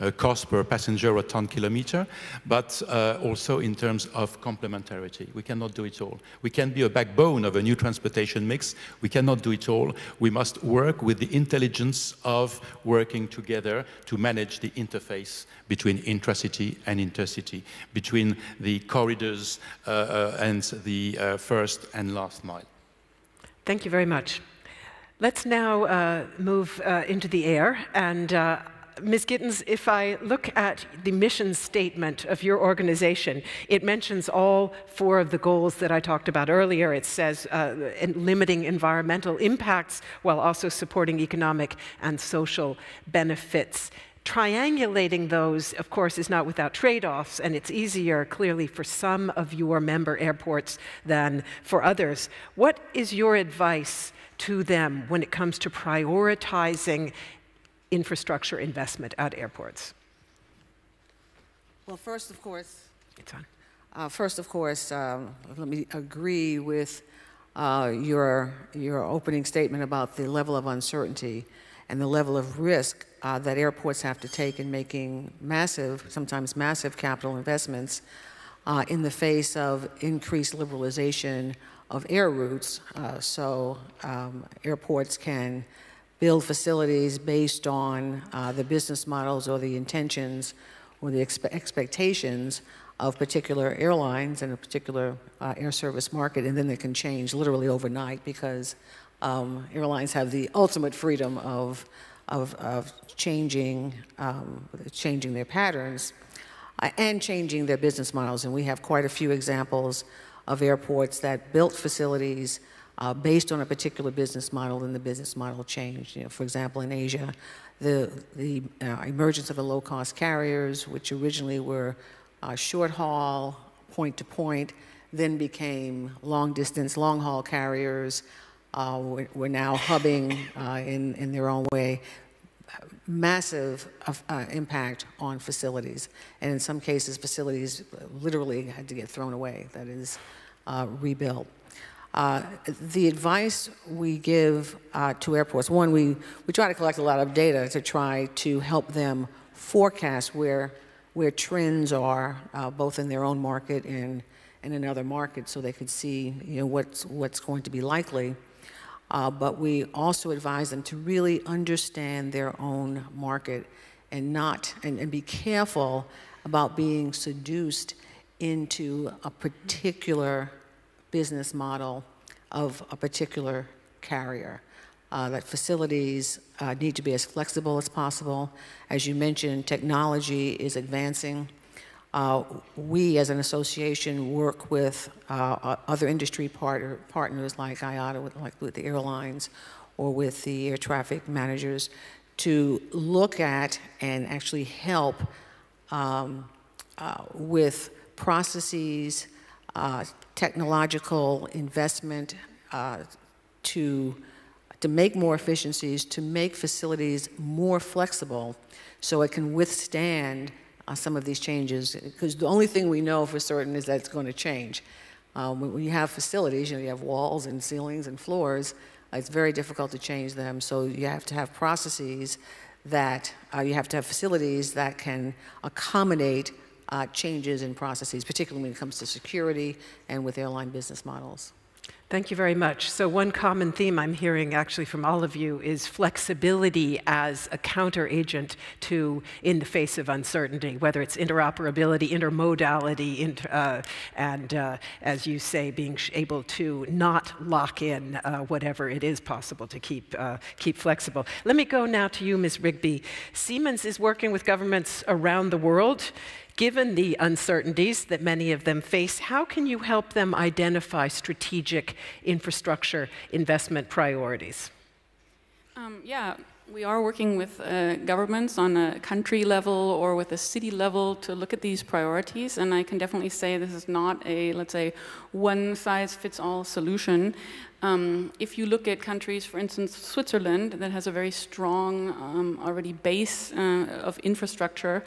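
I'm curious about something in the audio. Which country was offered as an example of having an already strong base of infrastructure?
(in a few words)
Switzerland.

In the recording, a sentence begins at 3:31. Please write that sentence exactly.
Because the only thing we know for certain is that it's going to change.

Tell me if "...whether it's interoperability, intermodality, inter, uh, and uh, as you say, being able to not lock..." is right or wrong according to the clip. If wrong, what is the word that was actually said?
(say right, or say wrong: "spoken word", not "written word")
right.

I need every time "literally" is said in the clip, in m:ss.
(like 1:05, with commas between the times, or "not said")
1:37, 2:18.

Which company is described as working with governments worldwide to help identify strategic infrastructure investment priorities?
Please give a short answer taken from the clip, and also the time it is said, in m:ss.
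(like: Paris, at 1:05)
Siemens, at 4:13.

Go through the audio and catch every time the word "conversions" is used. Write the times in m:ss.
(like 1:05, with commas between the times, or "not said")
not said.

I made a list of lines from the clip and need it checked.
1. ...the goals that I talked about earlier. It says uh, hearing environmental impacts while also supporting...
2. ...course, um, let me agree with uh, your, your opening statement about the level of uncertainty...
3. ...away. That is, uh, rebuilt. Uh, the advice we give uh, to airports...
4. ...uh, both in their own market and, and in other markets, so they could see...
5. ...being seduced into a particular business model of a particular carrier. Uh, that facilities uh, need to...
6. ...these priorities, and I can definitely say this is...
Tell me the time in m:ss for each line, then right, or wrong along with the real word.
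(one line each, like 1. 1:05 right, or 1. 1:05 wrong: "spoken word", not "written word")
1. 0:35 wrong: "limiting", not "hearing"
2. 1:04 right
3. 2:19 right
4. 2:32 right
5. 2:46 right
6. 4:31 right.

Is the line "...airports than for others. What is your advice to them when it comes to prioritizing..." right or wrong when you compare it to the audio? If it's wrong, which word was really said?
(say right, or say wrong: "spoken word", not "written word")
right.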